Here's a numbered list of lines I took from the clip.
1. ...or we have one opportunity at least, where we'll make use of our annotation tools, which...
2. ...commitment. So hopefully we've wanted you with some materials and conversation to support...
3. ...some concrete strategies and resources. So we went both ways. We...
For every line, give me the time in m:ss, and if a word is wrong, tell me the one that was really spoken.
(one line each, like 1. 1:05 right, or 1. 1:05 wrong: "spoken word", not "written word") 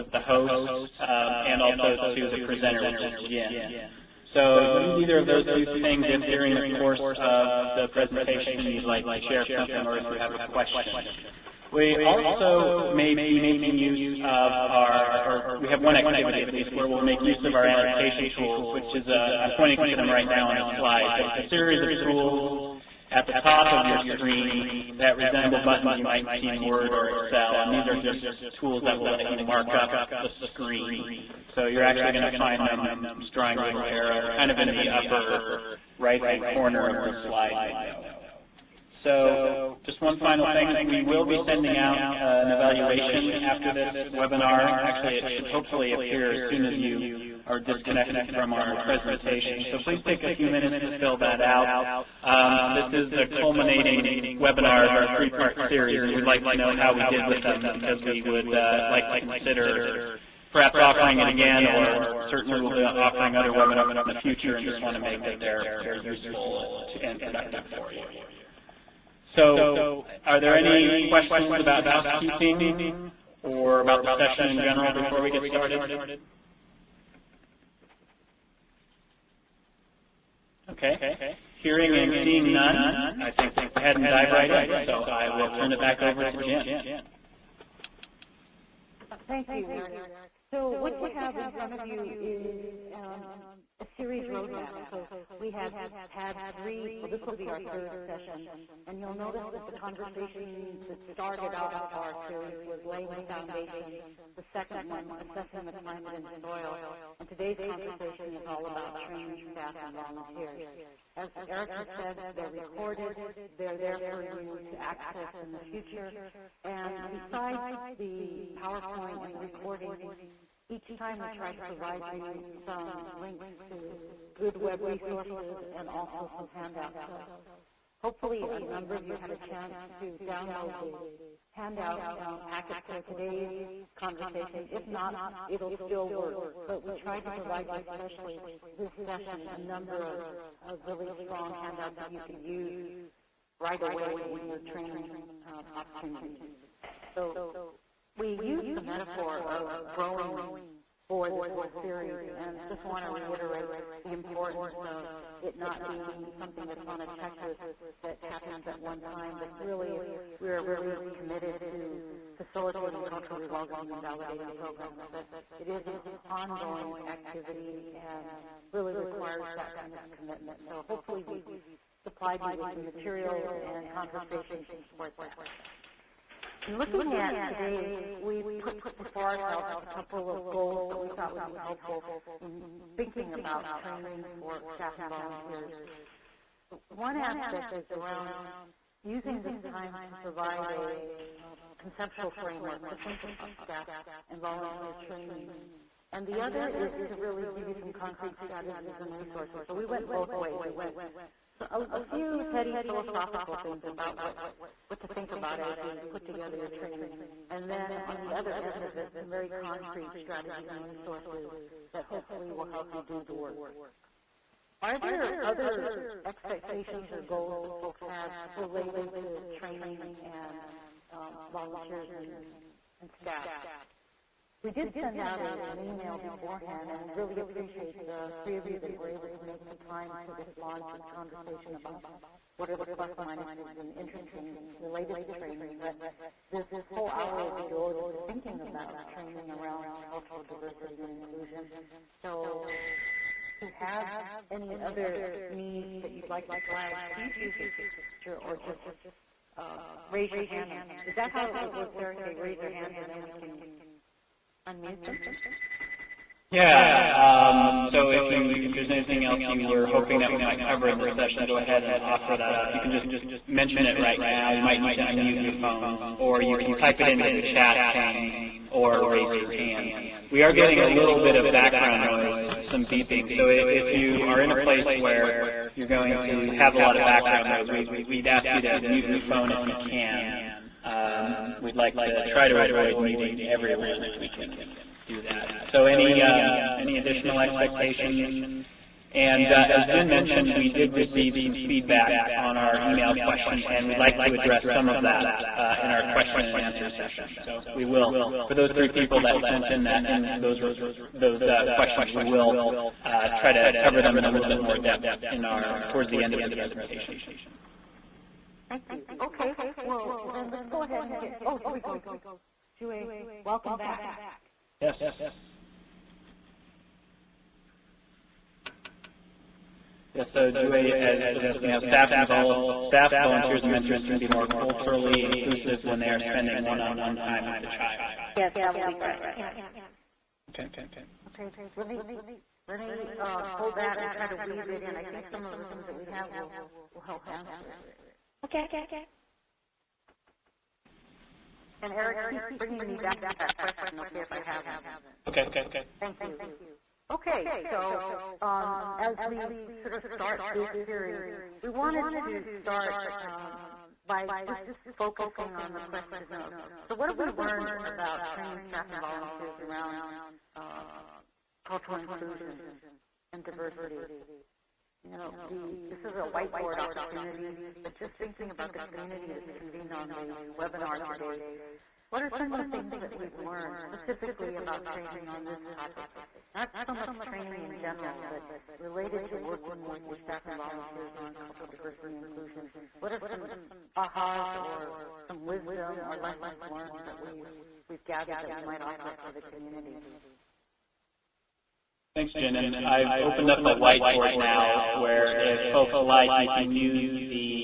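1. 0:15 wrong: "activity", not "opportunity"
2. 2:50 wrong: "supplied", not "wanted"
3. 3:17 right.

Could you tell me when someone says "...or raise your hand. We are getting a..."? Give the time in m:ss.
4:28.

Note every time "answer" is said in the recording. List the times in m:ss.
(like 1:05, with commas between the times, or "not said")
4:56, 5:37.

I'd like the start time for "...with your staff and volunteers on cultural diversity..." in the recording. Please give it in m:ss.
6:19.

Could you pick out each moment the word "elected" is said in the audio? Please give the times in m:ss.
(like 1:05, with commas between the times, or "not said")
not said.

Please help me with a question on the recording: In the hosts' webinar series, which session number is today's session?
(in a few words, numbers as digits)
third.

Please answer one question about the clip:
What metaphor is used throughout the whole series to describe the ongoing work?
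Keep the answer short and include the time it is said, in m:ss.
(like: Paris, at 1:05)
growing, at 2:29.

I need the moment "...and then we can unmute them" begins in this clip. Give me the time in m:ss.
4:12.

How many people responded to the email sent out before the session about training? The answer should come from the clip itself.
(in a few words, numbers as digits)
3.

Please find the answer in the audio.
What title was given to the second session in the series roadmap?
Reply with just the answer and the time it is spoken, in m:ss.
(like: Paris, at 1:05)
assessing the climate and soil, at 1:45.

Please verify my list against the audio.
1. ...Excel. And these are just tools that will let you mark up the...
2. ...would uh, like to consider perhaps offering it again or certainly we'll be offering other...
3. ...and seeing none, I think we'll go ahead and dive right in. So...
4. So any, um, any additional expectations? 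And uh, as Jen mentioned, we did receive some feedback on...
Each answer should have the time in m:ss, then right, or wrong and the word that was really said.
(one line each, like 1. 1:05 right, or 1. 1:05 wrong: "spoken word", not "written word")
1. 0:27 right
2. 0:58 right
3. 1:21 right
4. 4:45 right.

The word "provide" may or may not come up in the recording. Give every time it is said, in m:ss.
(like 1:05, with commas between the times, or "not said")
2:01, 2:17, 3:10.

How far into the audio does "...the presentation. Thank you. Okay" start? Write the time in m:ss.
5:06.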